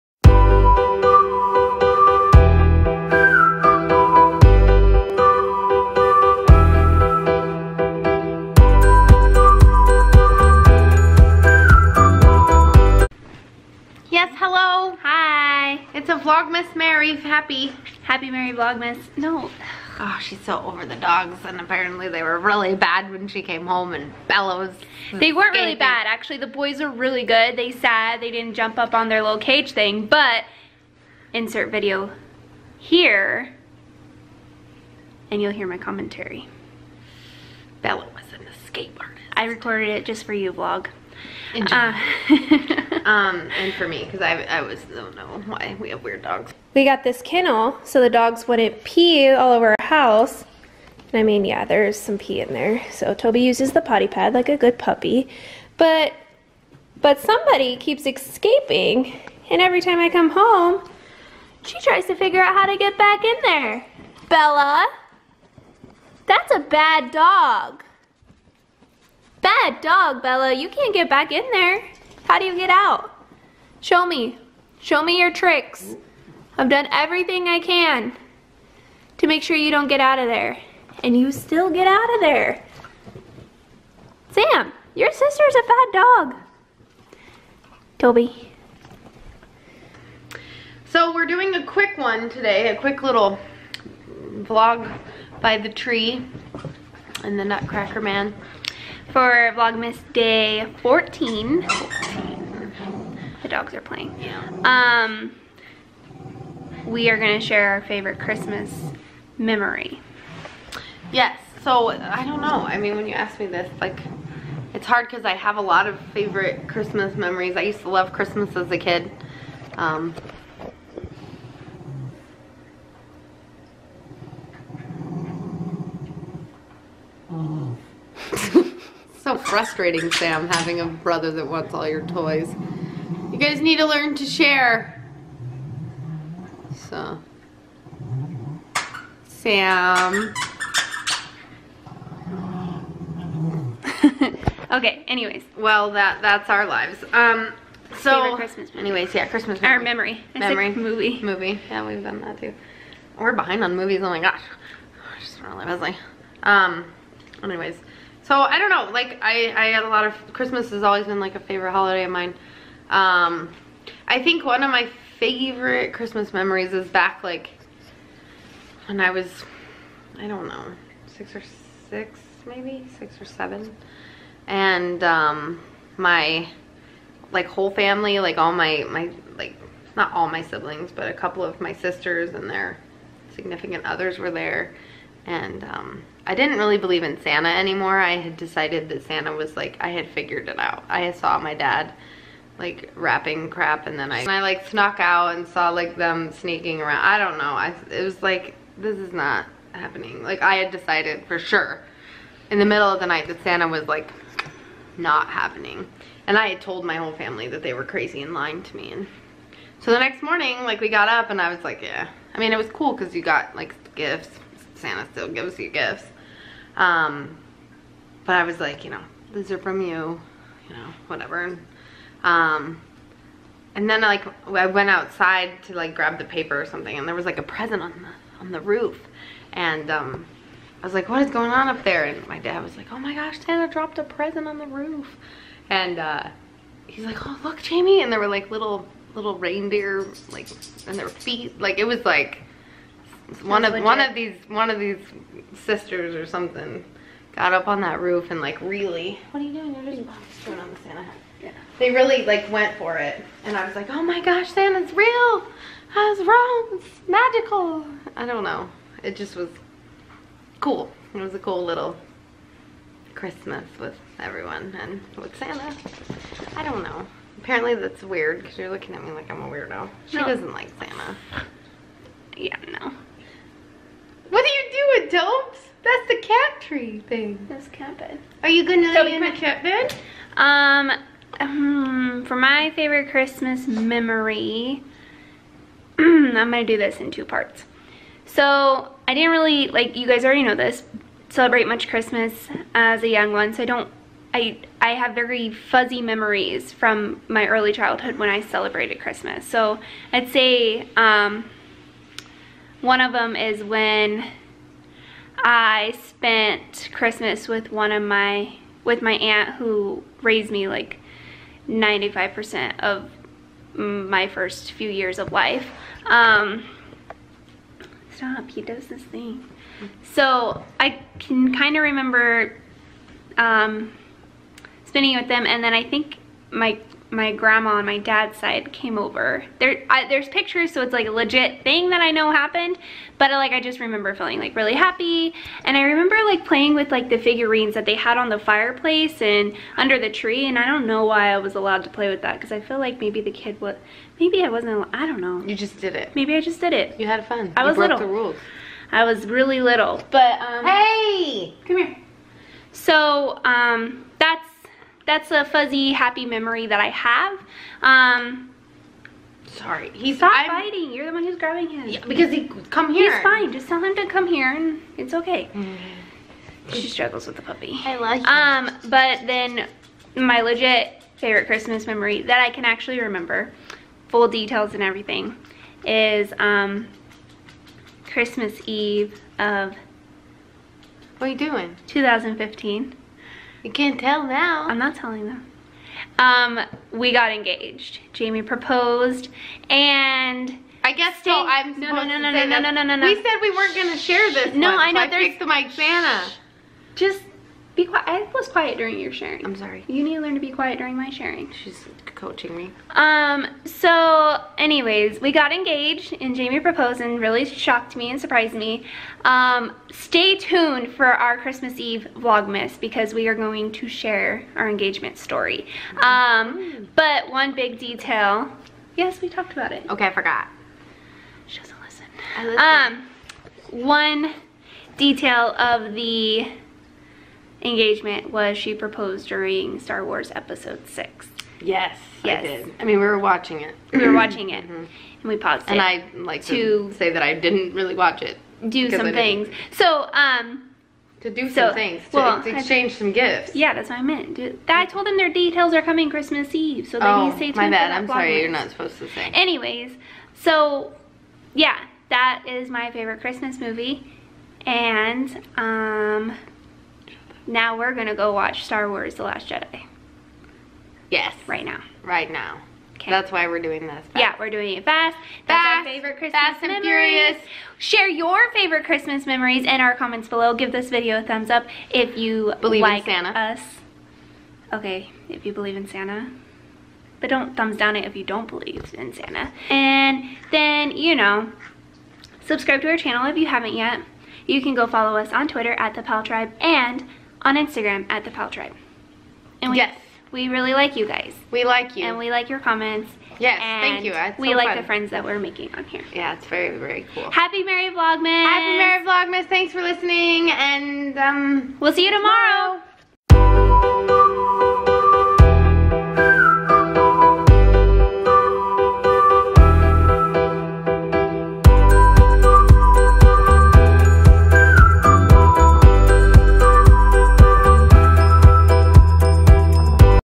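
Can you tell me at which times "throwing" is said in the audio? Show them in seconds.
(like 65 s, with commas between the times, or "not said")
250 s.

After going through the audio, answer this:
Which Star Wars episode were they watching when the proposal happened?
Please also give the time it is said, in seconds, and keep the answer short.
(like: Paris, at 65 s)
Episode 6, at 429 s.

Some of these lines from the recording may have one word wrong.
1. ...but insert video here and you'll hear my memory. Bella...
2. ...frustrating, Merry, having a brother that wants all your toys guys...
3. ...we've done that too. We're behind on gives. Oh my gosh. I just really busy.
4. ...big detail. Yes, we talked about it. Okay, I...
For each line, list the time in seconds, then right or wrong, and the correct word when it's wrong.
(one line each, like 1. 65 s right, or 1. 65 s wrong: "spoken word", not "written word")
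1. 30 s wrong: "commentary", not "memory"
2. 129 s wrong: "Sam", not "Merry"
3. 151 s wrong: "movies", not "gives"
4. 417 s right.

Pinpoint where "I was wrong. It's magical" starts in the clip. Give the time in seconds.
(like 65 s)
255 s.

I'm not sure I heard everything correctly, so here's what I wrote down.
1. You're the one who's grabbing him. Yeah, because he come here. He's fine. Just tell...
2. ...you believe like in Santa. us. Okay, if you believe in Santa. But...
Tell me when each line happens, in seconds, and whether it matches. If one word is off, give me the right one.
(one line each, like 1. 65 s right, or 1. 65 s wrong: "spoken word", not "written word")
1. 360 s right
2. 472 s right.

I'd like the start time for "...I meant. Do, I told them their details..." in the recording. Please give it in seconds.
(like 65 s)
443 s.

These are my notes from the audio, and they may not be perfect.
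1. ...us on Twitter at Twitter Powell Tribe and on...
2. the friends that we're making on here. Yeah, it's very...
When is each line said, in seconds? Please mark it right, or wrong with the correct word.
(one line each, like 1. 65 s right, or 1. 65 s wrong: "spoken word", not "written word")
1. 485 s wrong: "The", not "Twitter"
2. 494 s right.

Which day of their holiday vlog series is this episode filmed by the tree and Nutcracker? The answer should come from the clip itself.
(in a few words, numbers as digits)
14.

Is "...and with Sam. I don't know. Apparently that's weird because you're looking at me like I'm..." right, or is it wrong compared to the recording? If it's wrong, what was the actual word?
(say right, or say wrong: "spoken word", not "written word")
wrong: "Santa", not "Sam".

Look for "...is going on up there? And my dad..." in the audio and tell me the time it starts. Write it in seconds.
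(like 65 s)
231 s.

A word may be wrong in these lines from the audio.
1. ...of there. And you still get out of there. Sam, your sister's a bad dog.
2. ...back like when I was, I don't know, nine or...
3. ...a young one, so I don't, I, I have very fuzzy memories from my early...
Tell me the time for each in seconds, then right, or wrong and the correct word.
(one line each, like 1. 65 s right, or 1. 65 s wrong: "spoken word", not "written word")
1. 80 s right
2. 166 s wrong: "six", not "nine"
3. 293 s right.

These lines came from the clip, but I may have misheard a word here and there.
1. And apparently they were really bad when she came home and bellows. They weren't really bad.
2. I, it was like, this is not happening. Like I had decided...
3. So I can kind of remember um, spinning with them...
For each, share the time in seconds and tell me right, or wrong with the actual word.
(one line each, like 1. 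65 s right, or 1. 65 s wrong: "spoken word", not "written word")
1. 21 s right
2. 197 s right
3. 320 s right.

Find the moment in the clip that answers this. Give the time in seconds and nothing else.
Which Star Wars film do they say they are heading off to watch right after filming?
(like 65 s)
458 s.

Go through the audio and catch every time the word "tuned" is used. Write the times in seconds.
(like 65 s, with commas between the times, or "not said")
410 s, 447 s.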